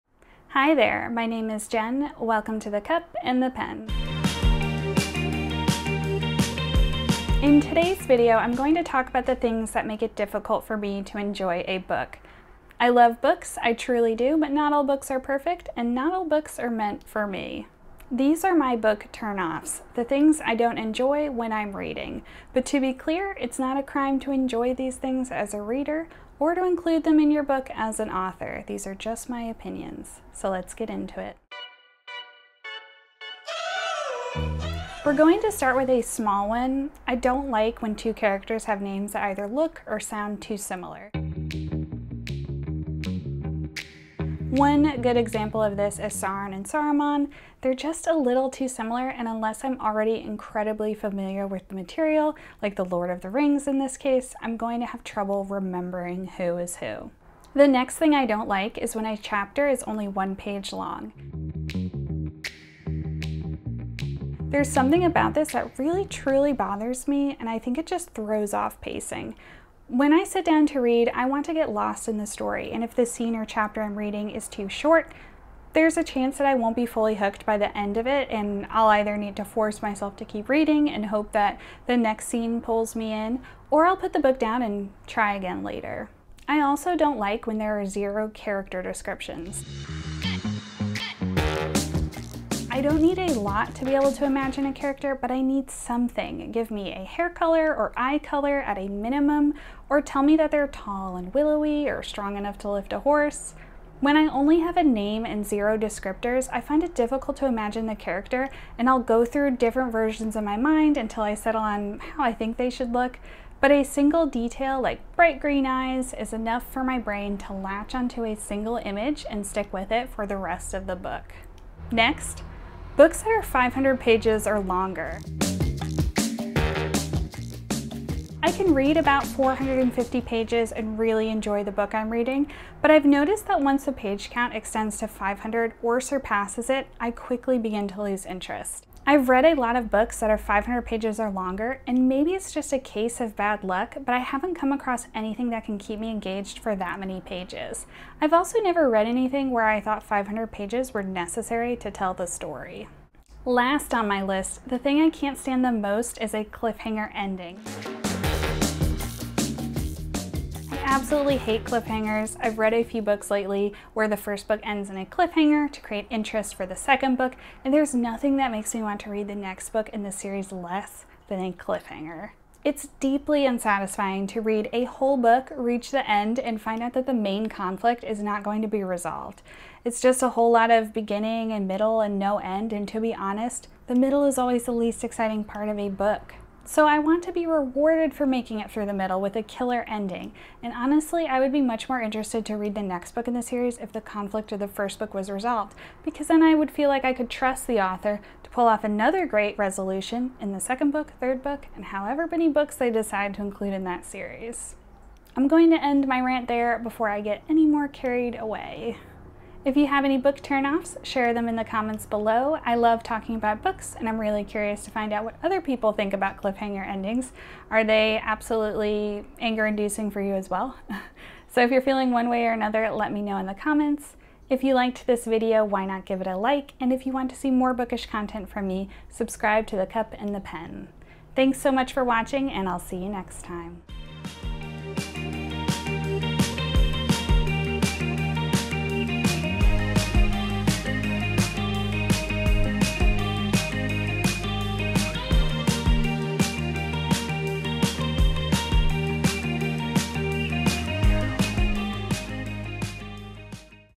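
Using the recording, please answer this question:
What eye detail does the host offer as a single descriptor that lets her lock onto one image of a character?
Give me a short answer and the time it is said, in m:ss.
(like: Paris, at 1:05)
bright green eyes, at 1:55.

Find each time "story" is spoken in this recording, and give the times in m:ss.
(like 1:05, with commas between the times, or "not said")
1:12, 2:32.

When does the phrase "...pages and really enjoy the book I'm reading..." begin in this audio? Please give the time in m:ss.
2:10.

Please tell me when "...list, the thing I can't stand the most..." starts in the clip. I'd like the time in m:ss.
2:34.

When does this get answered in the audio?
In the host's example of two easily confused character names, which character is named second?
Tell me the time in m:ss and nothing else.
0:46.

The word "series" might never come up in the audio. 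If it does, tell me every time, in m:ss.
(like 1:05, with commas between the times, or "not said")
2:50, 3:13, 3:24.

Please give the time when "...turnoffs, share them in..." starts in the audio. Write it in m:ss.
3:30.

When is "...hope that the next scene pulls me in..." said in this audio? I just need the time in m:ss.
1:21.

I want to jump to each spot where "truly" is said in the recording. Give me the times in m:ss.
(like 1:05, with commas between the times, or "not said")
0:13, 1:06.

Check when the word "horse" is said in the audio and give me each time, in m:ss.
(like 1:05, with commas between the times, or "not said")
1:43.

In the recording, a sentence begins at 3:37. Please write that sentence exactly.
Are they absolutely anger inducing for you as well?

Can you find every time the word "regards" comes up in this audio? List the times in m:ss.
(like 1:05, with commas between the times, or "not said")
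not said.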